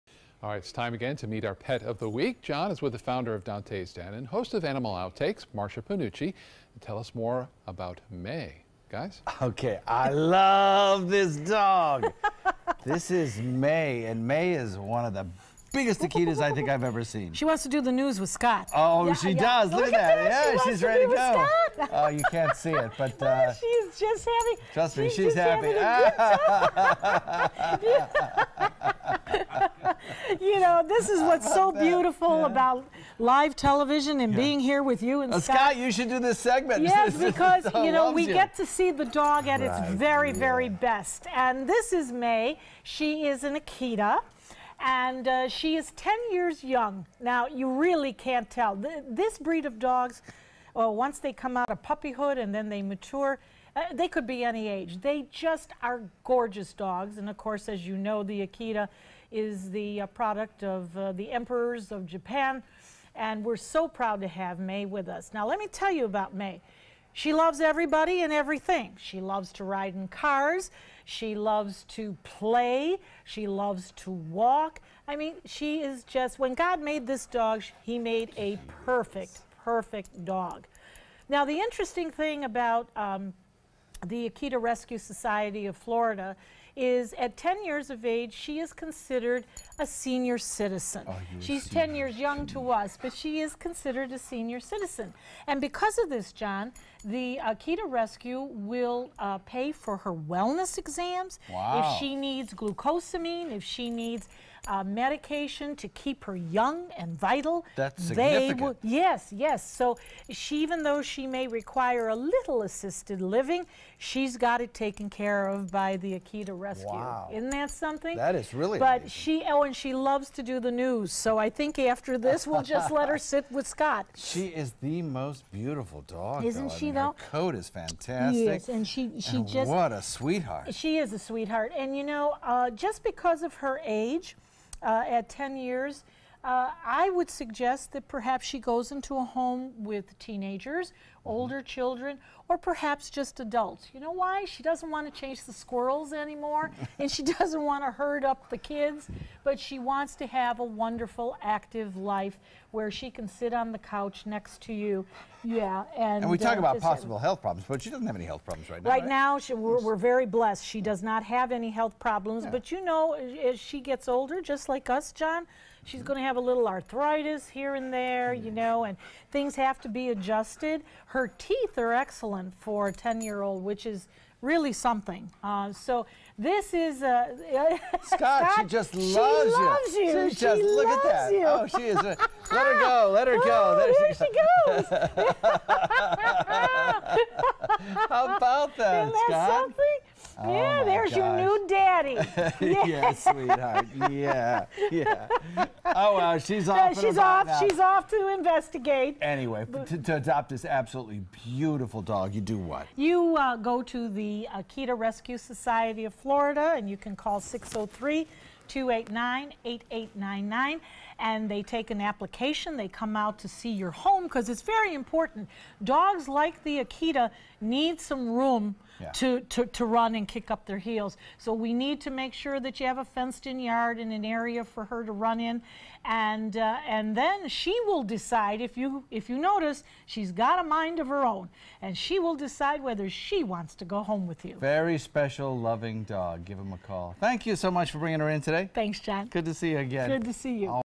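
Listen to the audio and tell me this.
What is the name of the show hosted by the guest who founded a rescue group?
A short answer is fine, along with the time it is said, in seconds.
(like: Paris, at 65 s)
Animal Outtakes, at 4 s.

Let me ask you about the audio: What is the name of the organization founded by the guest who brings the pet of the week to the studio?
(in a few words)
Dante's Den.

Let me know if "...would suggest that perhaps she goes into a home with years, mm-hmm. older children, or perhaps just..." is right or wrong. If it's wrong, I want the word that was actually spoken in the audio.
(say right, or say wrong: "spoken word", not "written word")
wrong: "teenagers", not "years".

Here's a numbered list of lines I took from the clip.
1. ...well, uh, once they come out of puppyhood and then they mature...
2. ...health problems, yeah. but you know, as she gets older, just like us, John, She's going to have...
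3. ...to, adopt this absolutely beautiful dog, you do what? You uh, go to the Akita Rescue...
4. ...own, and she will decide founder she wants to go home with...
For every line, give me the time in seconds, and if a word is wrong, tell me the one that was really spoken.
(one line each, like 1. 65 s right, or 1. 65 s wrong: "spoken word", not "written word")
1. 50 s right
2. 161 s right
3. 199 s right
4. 231 s wrong: "whether", not "founder".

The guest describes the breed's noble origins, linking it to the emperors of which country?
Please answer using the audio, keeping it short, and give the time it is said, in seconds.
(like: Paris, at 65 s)
Japan, at 62 s.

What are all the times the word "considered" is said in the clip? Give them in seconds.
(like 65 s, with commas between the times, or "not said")
88 s, 93 s.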